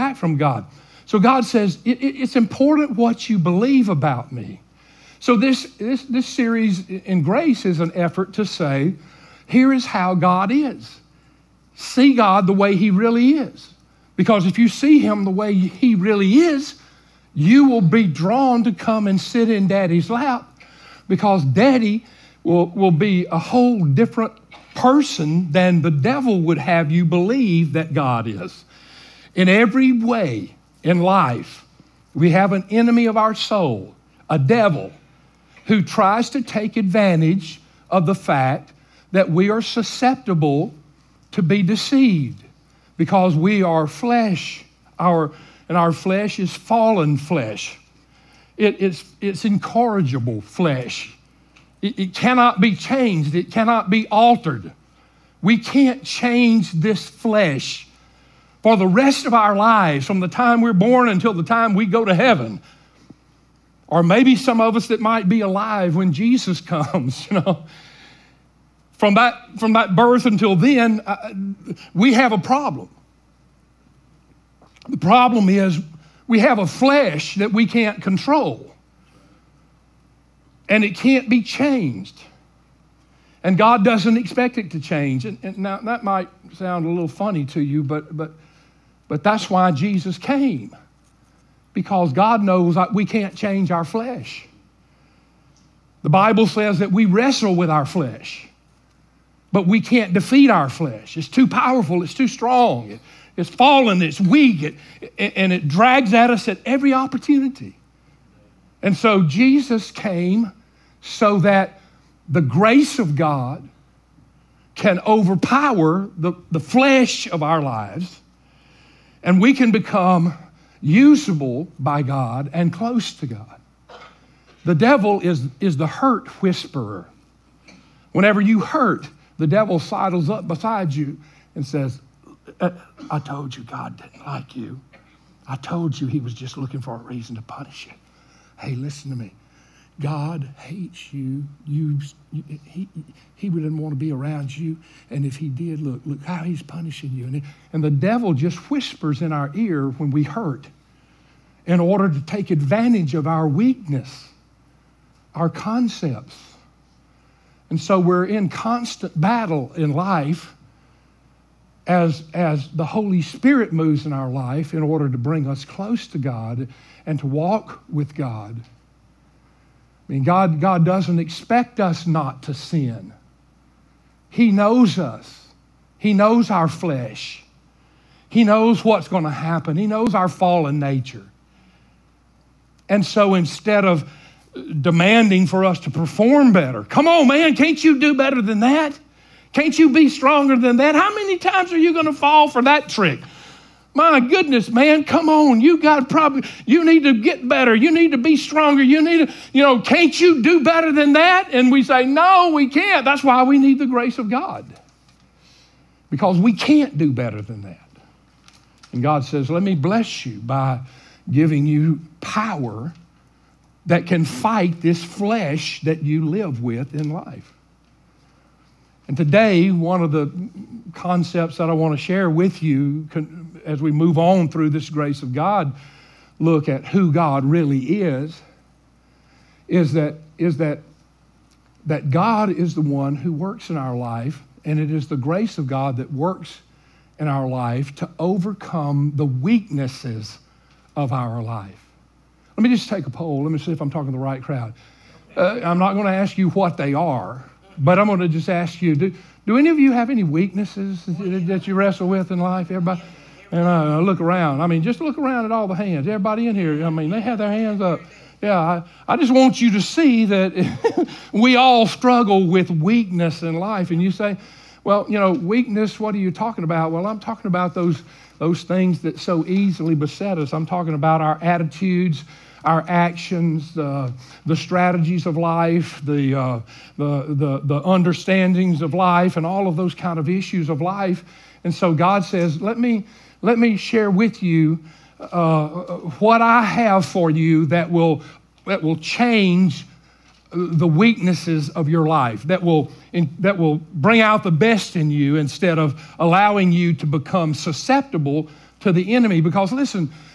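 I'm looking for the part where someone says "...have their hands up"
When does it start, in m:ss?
4:17.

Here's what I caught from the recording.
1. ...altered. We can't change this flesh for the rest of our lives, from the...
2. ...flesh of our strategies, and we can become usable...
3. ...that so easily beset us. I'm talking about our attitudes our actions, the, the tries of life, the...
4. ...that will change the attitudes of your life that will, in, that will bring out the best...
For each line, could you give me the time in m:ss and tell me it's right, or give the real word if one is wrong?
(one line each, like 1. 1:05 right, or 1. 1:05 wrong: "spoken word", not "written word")
1. 0:54 right
2. 1:56 wrong: "lives", not "strategies"
3. 4:29 wrong: "strategies", not "tries"
4. 4:48 wrong: "weaknesses", not "attitudes".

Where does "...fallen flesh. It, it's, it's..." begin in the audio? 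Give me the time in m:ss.
0:46.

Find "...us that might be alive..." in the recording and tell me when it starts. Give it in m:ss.
1:04.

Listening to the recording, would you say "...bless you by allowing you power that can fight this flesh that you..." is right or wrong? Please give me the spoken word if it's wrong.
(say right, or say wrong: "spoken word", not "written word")
wrong: "giving", not "allowing".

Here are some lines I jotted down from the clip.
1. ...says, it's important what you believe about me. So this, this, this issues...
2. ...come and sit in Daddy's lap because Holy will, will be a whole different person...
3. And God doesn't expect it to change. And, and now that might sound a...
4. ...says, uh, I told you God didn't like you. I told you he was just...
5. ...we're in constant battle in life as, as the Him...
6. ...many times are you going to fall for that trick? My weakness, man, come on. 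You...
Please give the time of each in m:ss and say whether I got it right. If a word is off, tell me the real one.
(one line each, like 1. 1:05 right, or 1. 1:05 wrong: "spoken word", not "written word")
1. 0:01 wrong: "series", not "issues"
2. 0:18 wrong: "Daddy", not "Holy"
3. 1:23 right
4. 2:11 right
5. 2:38 wrong: "Holy", not "Him"
6. 3:11 wrong: "goodness", not "weakness".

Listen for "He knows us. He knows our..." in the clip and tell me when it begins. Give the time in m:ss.
2:54.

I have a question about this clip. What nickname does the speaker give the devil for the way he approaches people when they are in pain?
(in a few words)
the hurt whisperer.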